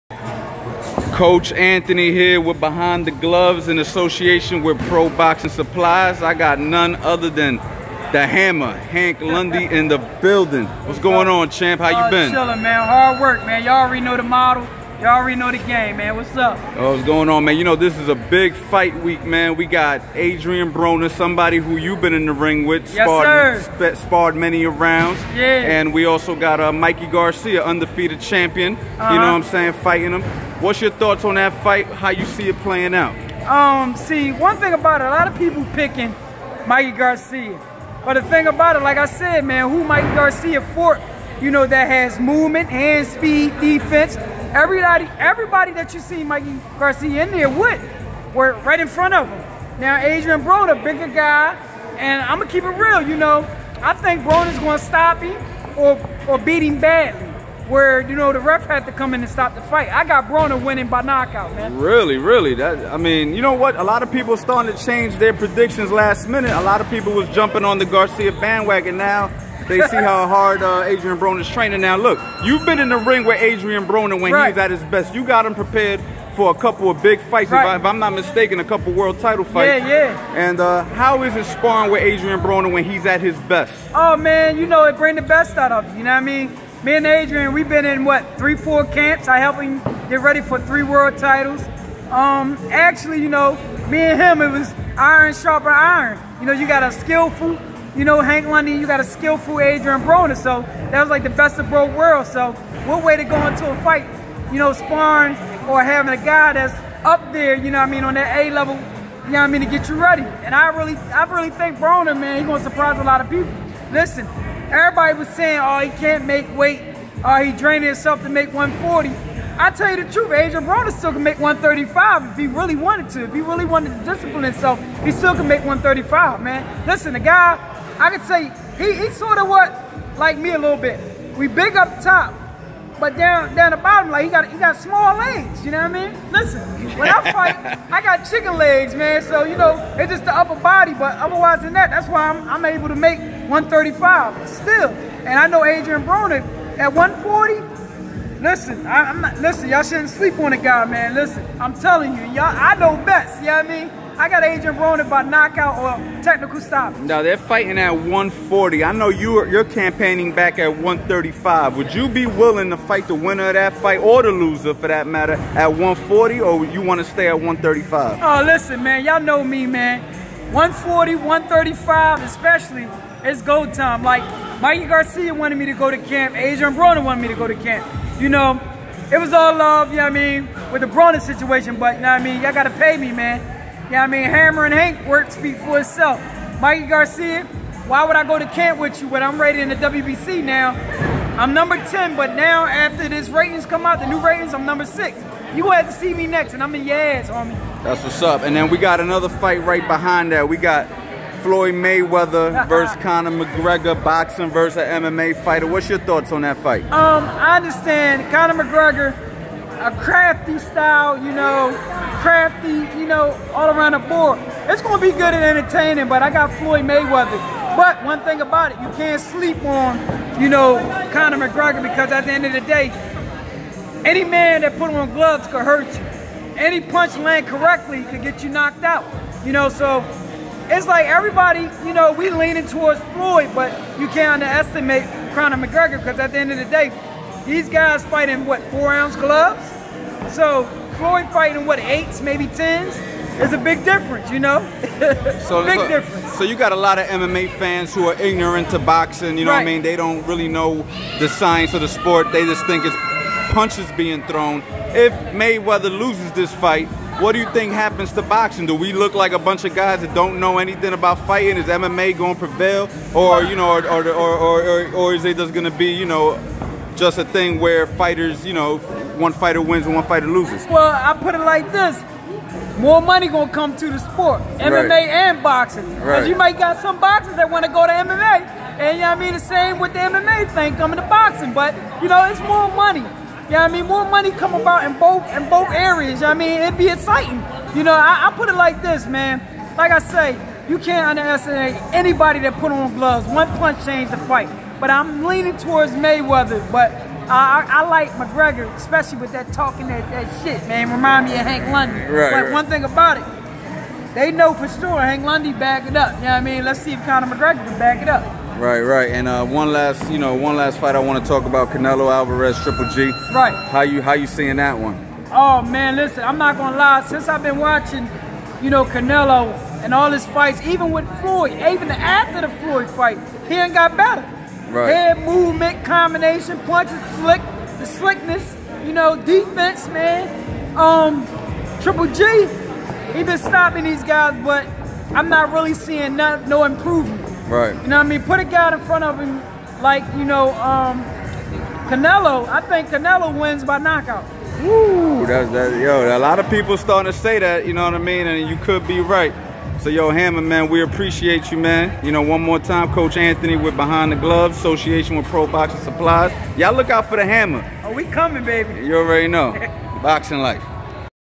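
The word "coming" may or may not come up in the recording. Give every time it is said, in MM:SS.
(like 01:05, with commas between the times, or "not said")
04:40, 05:58.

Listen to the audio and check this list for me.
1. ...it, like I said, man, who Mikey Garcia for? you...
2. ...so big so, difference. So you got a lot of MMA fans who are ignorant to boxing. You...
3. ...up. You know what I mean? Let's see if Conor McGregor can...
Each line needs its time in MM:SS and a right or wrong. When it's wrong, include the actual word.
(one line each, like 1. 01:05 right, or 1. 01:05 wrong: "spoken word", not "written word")
1. 00:38 right
2. 04:05 right
3. 05:05 right.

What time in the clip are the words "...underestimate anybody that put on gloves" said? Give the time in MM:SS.
04:51.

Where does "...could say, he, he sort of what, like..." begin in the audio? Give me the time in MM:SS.
02:08.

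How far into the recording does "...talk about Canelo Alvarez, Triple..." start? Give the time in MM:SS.
05:11.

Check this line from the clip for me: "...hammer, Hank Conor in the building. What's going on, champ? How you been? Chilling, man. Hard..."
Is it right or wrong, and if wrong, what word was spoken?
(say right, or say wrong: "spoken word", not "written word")
wrong: "Lundy", not "Conor".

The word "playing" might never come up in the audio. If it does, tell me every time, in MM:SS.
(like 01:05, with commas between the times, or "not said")
00:32.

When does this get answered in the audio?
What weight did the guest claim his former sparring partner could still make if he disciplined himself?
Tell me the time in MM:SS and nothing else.
02:05.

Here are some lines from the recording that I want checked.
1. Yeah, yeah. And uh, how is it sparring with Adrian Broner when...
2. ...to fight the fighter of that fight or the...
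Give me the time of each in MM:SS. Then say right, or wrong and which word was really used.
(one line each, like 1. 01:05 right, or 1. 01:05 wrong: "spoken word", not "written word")
1. 01:19 right
2. 02:42 wrong: "winner", not "fighter".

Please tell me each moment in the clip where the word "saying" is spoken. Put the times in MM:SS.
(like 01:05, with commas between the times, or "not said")
00:29, 01:55.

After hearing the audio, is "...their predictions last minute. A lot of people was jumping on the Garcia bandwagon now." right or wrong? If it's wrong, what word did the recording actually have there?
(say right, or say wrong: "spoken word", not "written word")
right.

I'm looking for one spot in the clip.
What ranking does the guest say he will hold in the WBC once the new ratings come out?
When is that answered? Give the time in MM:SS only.
03:14.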